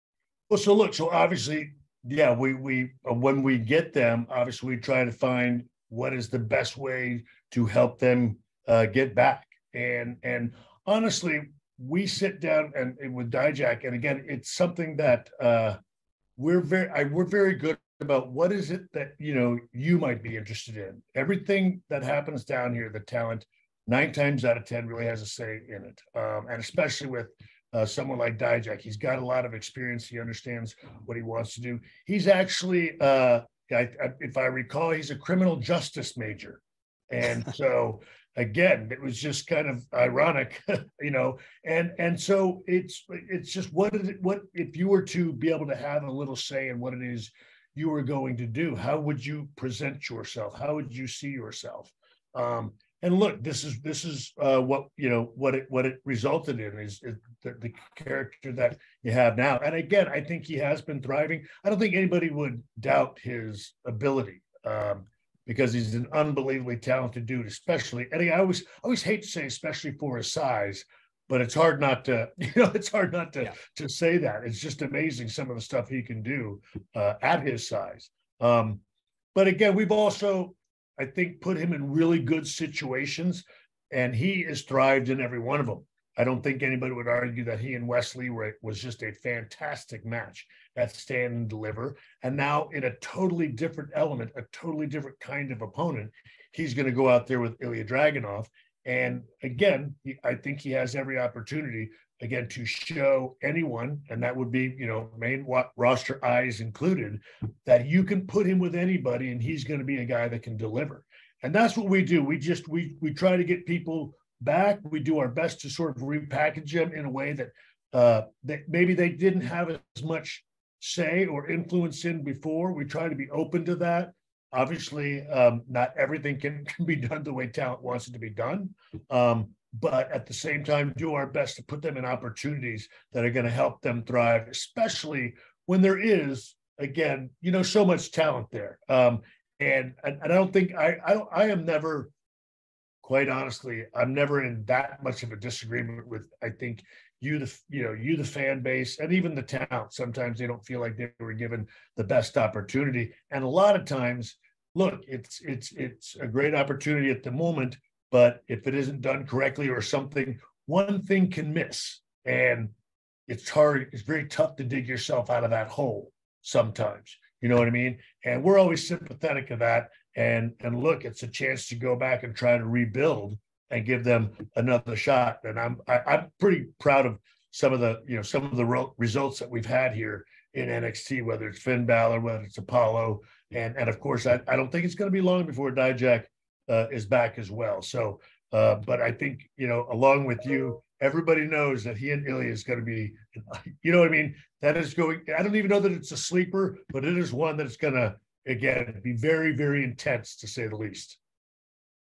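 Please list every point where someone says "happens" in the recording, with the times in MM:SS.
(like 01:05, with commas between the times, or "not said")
00:22.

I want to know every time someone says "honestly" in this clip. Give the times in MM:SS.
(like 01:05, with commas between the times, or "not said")
00:10, 02:23.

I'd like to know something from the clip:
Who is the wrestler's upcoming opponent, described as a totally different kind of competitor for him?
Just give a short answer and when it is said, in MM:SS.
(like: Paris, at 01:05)
Ilya Dragunov, at 01:37.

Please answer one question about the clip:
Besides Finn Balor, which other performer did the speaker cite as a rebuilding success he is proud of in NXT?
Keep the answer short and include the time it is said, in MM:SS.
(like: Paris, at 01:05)
Apollo, at 03:02.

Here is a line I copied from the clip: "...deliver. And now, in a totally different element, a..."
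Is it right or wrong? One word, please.
right.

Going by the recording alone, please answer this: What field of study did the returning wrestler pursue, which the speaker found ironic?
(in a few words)
Criminal justice.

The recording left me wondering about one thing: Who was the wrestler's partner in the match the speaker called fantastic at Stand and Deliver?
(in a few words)
Wes Lee.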